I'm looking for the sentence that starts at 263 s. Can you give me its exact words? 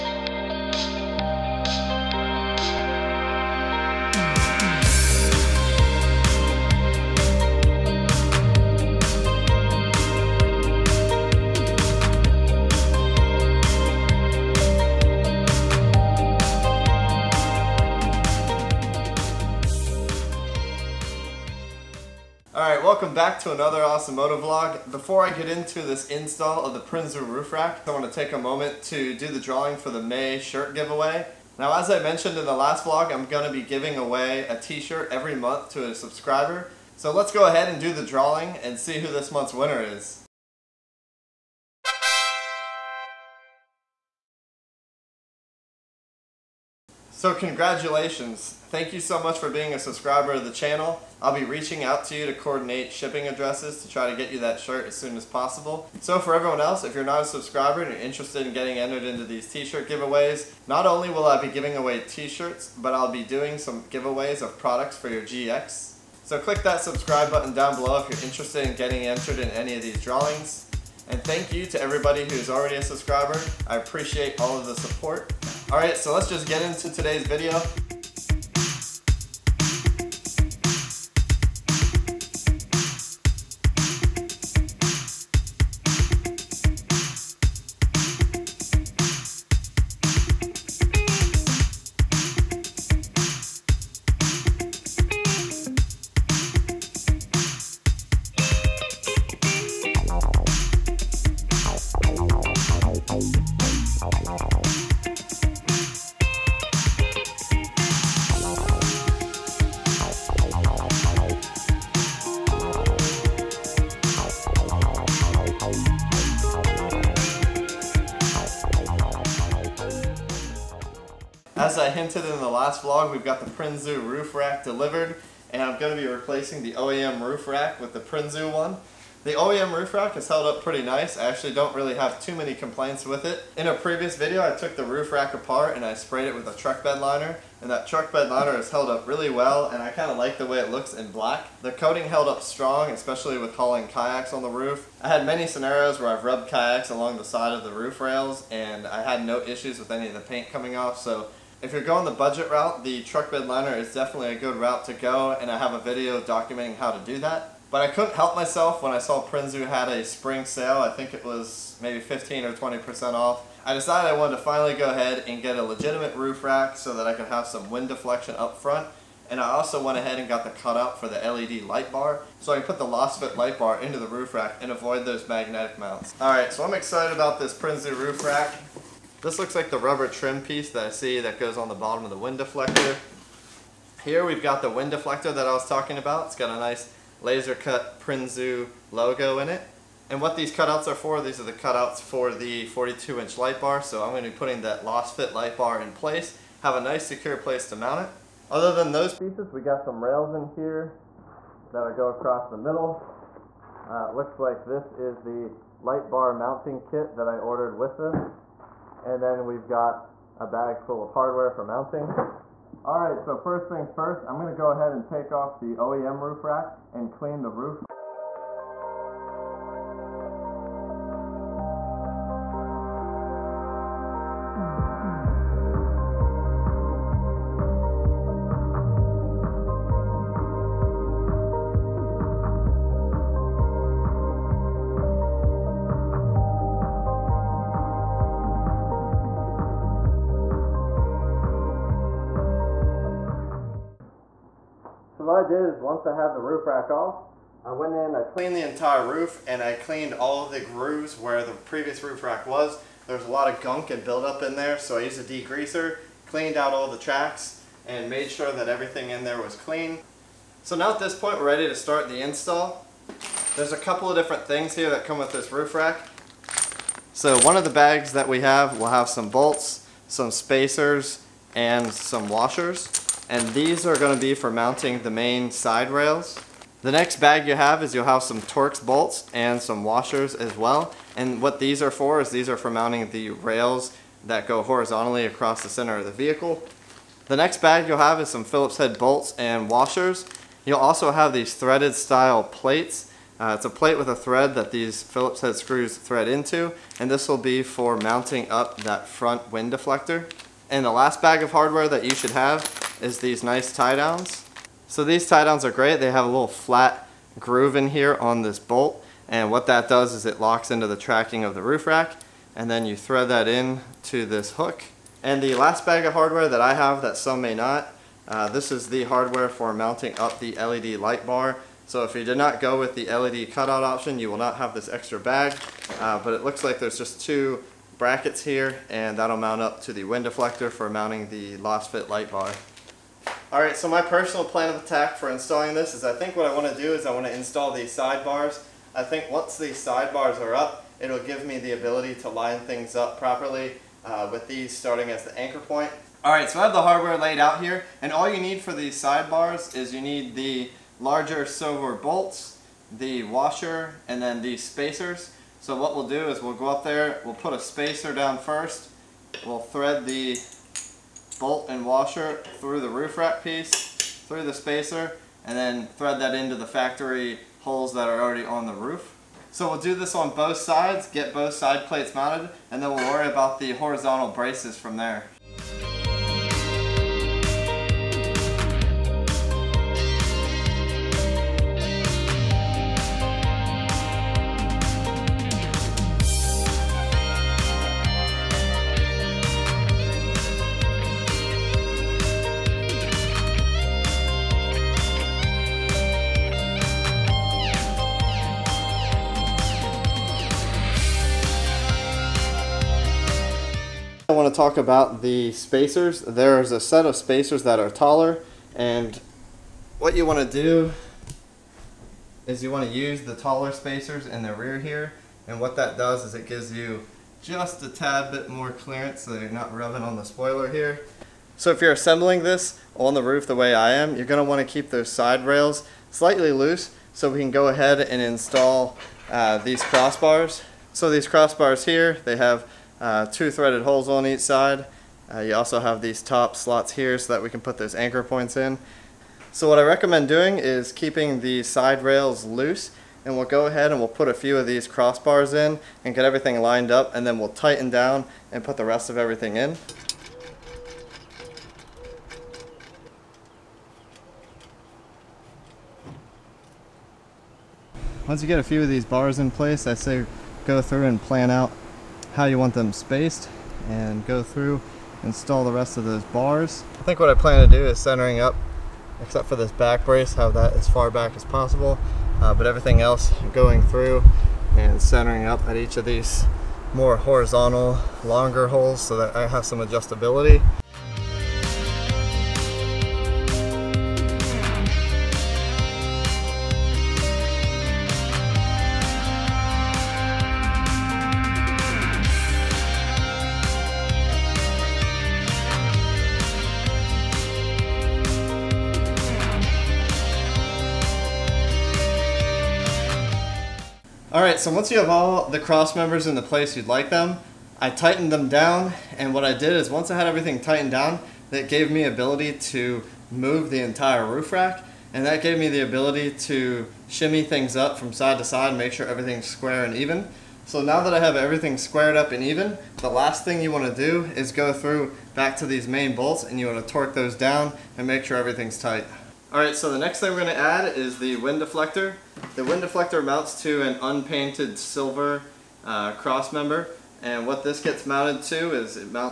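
There's a couple of different things here that come with this roof rack.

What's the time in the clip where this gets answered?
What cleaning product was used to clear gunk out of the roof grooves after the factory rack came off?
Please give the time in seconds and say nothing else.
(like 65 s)
255 s.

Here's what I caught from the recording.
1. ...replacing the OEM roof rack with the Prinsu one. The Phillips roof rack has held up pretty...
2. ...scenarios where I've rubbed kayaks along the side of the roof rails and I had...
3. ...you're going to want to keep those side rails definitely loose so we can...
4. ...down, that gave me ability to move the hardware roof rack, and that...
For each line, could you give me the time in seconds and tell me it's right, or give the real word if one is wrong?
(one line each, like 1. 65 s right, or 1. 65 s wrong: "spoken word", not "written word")
1. 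126 s wrong: "OEM", not "Phillips"
2. 145 s right
3. 424 s wrong: "slightly", not "definitely"
4. 510 s wrong: "entire", not "hardware".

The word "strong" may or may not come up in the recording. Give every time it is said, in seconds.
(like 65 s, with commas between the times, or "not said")
142 s.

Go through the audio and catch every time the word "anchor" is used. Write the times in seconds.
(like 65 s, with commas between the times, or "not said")
345 s, 437 s.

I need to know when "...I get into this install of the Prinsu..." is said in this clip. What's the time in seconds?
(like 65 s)
25 s.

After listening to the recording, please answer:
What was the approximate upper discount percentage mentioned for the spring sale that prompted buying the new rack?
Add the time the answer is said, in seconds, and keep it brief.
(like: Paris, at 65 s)
20%, at 162 s.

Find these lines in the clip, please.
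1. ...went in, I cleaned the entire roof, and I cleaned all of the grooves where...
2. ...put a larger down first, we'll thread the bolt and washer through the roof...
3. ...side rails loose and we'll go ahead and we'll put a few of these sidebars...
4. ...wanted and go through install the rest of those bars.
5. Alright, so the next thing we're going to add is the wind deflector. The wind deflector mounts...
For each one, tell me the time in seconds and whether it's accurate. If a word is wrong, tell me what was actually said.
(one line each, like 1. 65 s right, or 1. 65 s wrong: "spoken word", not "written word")
1. 247 s right
2. 357 s wrong: "spacer", not "larger"
3. 441 s wrong: "crossbars", not "sidebars"
4. 462 s wrong: "spaced", not "wanted"
5. 529 s right.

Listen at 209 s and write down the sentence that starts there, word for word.
And then we've got a bag full of hardware for mounting.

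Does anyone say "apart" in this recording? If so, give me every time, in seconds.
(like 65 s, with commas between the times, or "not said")
135 s.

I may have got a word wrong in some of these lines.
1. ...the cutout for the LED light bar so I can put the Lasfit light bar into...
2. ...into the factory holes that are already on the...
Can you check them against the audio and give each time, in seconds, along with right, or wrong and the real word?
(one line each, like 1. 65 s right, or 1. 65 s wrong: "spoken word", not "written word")
1. 170 s right
2. 366 s right.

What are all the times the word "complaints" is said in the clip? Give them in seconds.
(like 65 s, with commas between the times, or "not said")
132 s.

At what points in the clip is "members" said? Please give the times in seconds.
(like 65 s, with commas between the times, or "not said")
505 s, 536 s.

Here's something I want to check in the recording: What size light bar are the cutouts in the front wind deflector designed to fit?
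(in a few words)
42 inch.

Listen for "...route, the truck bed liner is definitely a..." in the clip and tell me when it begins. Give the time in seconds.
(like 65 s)
152 s.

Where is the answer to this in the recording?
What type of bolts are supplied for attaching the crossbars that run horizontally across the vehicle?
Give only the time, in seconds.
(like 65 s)
278 s.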